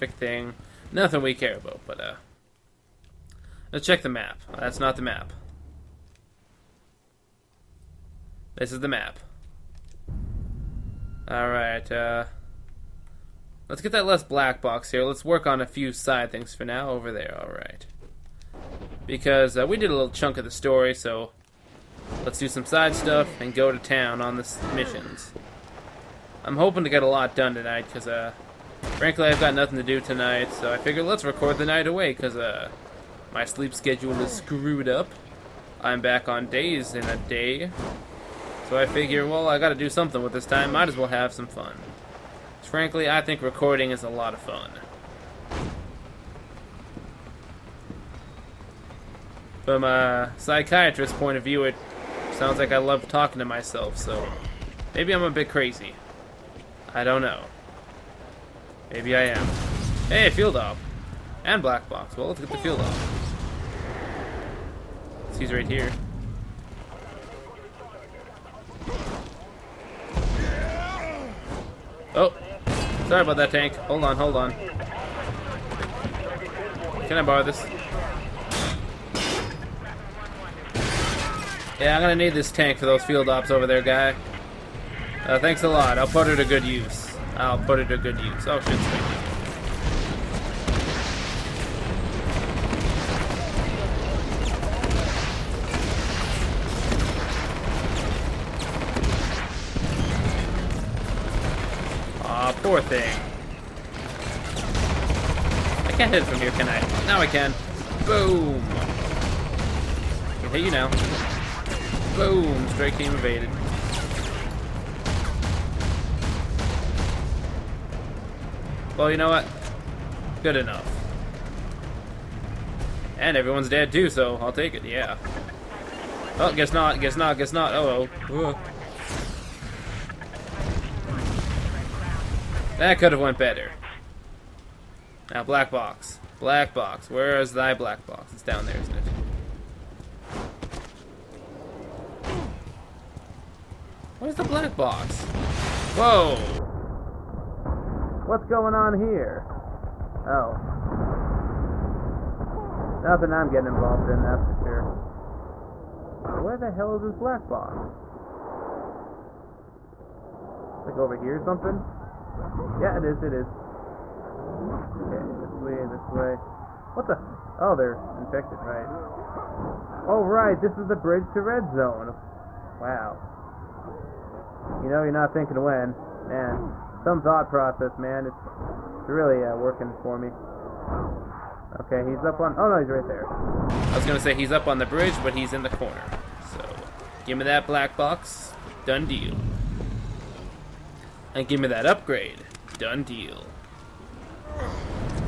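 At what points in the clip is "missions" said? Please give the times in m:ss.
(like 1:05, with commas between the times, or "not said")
0:24.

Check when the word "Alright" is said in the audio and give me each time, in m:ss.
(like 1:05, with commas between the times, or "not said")
0:11, 0:17.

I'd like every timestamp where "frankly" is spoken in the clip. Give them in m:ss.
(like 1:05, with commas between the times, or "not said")
0:28, 0:42.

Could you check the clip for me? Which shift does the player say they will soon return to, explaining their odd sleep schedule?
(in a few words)
Days.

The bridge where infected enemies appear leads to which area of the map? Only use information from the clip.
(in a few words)
Red Zone.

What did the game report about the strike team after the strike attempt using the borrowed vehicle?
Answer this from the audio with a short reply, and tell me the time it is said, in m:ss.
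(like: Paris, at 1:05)
Evaded, at 1:52.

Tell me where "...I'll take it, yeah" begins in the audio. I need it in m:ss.
2:04.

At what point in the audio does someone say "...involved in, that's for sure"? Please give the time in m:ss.
2:33.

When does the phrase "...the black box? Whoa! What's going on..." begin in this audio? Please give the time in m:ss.
2:24.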